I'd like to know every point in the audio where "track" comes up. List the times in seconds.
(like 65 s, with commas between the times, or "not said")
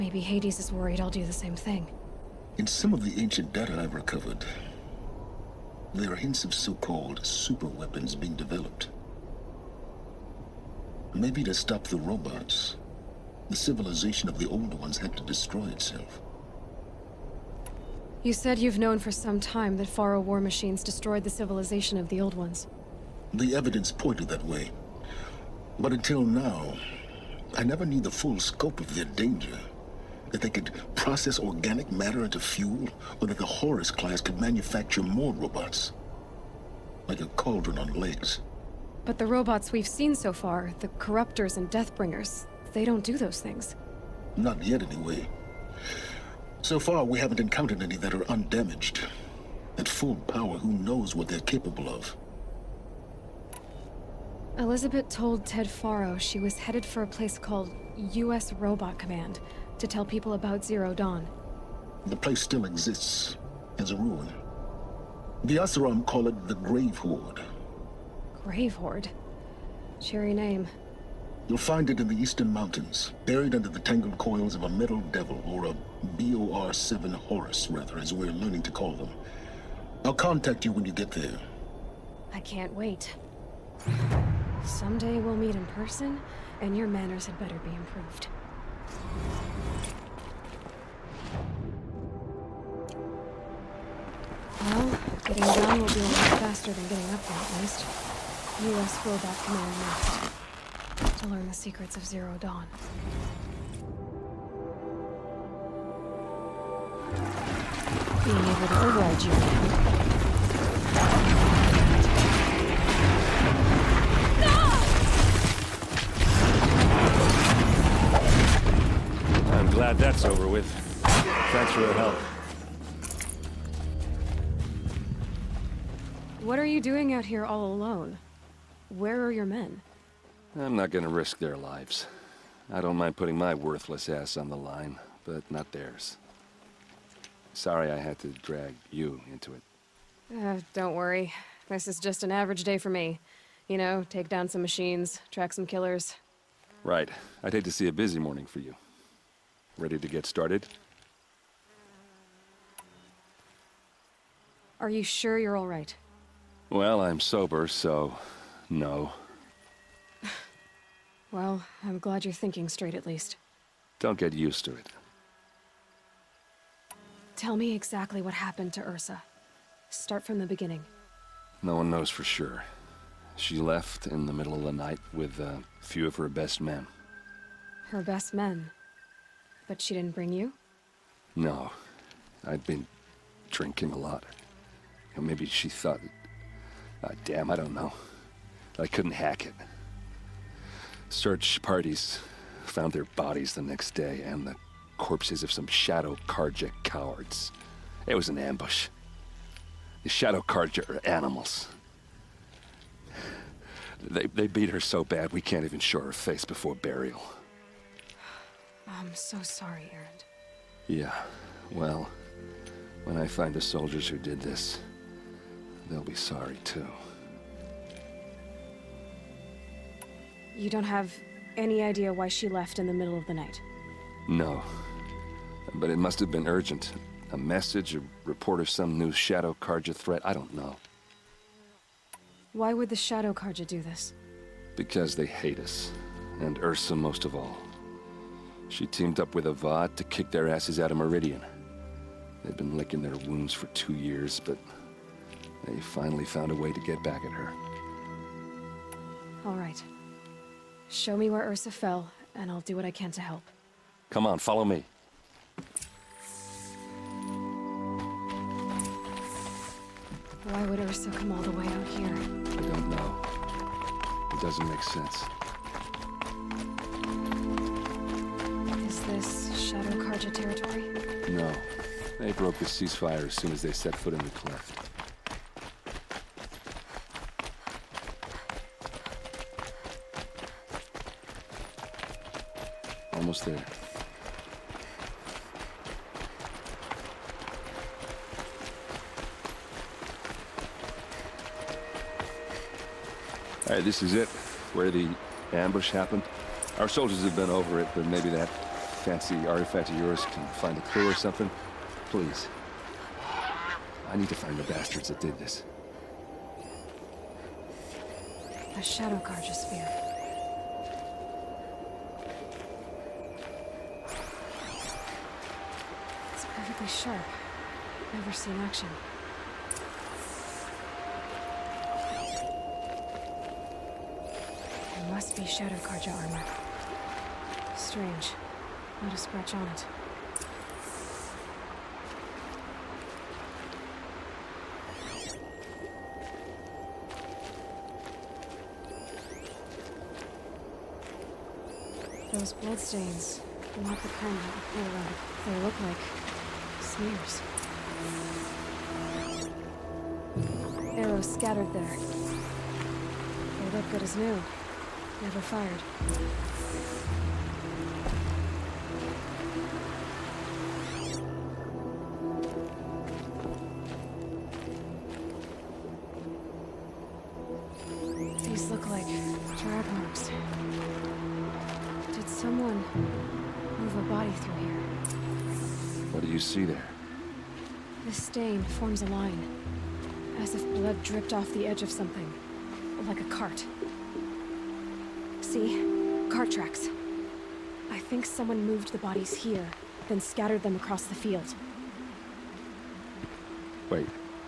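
145 s, 386 s.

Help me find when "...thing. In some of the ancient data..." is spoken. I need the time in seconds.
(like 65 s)
1 s.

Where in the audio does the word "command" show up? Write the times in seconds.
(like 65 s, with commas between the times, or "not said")
58 s, 99 s.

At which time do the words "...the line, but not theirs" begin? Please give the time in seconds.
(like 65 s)
134 s.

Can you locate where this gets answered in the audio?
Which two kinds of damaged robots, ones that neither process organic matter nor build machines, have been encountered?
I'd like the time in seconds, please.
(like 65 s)
40 s.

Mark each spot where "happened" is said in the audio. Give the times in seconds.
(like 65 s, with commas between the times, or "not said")
168 s, 295 s.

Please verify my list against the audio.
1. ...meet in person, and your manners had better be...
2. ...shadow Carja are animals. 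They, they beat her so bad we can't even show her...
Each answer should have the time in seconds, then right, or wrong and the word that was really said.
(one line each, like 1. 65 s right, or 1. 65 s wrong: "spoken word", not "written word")
1. 85 s right
2. 200 s right.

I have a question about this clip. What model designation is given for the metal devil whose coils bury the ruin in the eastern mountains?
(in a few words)
BOR-7 Horus.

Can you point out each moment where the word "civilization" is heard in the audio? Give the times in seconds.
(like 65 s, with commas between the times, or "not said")
13 s, 21 s.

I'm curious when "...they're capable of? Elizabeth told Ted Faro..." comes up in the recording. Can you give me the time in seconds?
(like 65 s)
51 s.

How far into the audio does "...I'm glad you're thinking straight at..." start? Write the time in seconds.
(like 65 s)
161 s.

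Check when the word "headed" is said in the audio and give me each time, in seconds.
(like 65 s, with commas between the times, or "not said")
56 s.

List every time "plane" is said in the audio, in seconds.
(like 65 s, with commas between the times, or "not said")
not said.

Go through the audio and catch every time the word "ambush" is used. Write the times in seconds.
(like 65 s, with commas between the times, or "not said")
198 s, 295 s.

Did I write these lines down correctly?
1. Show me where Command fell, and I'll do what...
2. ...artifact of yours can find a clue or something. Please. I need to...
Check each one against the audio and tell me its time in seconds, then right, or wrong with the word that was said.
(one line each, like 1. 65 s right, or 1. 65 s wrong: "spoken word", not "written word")
1. 250 s wrong: "Ursa", not "Command"
2. 299 s right.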